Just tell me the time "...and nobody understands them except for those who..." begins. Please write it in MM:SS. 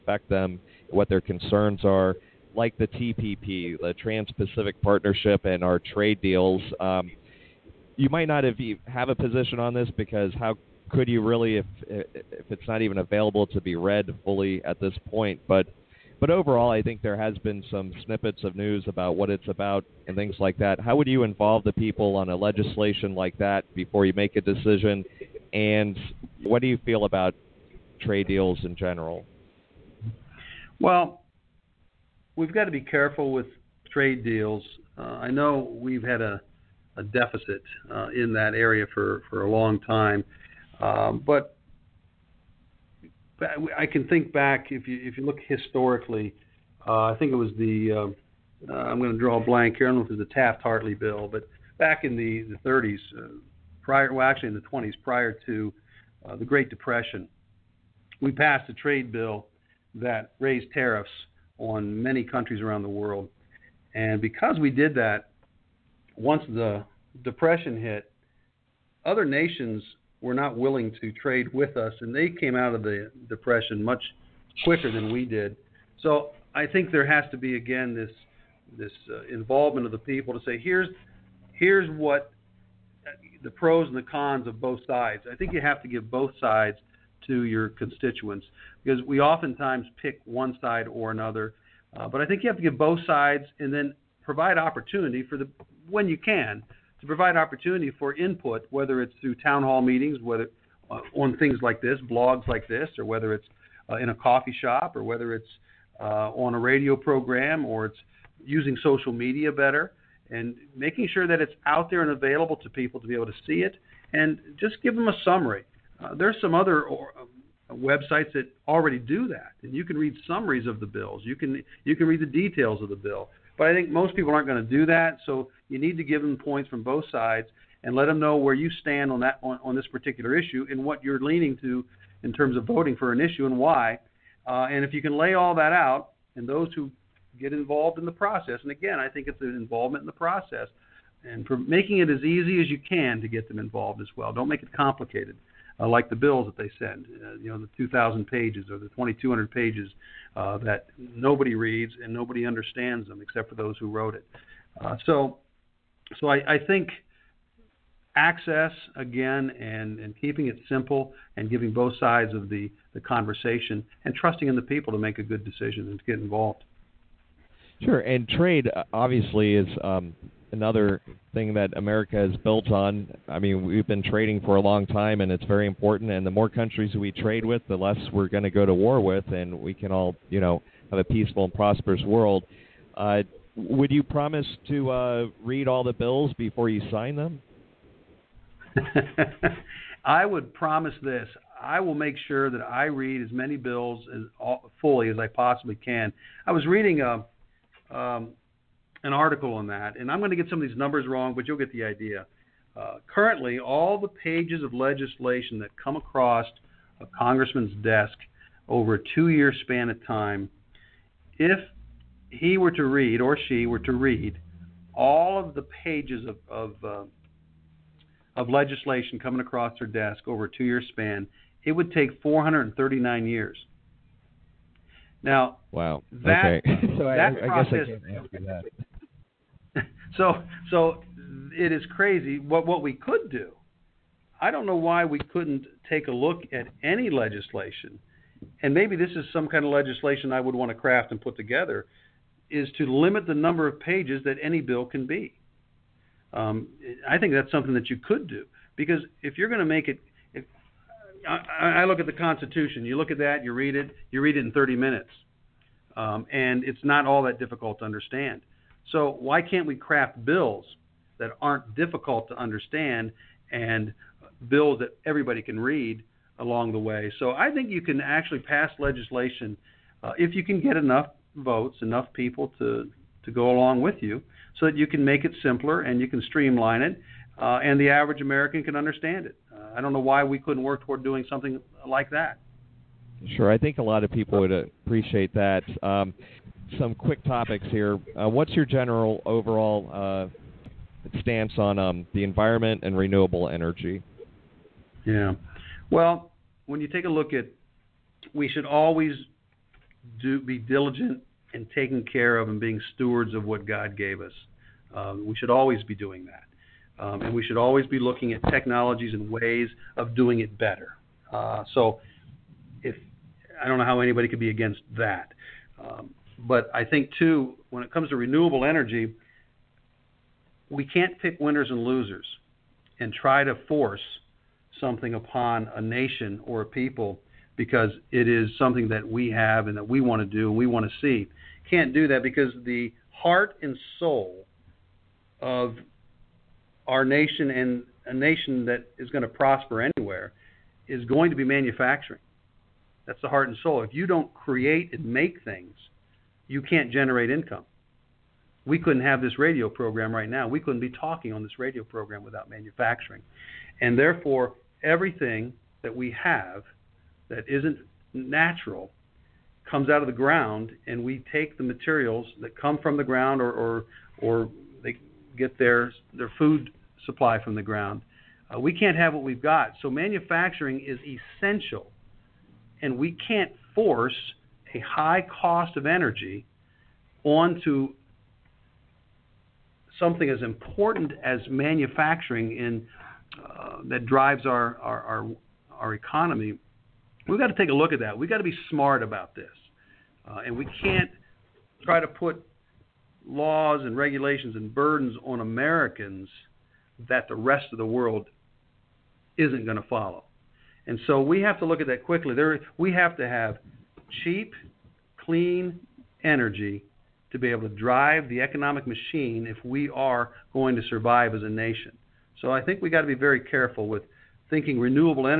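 02:32.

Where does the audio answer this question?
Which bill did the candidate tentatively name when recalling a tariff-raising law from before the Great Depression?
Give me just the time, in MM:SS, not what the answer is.
00:50.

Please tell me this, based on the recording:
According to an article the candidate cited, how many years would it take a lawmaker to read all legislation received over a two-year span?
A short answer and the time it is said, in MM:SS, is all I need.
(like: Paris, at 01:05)
439 years, at 03:42.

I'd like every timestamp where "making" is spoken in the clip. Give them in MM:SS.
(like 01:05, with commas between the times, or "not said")
01:50, 02:21.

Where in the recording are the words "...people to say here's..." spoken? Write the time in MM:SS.
01:19.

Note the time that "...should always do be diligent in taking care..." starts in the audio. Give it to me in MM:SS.
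04:58.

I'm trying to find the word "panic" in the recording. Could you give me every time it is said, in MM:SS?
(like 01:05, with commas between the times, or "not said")
not said.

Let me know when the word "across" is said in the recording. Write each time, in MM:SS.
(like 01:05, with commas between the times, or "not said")
03:25, 03:39.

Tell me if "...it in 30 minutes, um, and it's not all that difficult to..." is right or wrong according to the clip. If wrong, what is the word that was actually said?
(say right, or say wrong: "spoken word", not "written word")
right.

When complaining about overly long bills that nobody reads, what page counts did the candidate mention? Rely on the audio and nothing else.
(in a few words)
2,000 or 2,200 pages.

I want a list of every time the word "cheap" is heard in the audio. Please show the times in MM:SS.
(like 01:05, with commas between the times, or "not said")
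06:44.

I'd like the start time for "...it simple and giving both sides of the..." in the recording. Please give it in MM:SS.
02:40.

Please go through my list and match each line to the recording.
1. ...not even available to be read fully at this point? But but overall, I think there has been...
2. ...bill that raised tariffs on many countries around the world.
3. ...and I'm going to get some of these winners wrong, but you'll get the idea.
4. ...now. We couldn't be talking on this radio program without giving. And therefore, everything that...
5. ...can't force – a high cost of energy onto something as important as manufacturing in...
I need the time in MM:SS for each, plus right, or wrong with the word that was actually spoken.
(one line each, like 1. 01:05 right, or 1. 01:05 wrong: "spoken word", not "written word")
1. 00:12 right
2. 00:59 right
3. 03:19 wrong: "numbers", not "winners"
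4. 05:50 wrong: "manufacturing", not "giving"
5. 06:13 right.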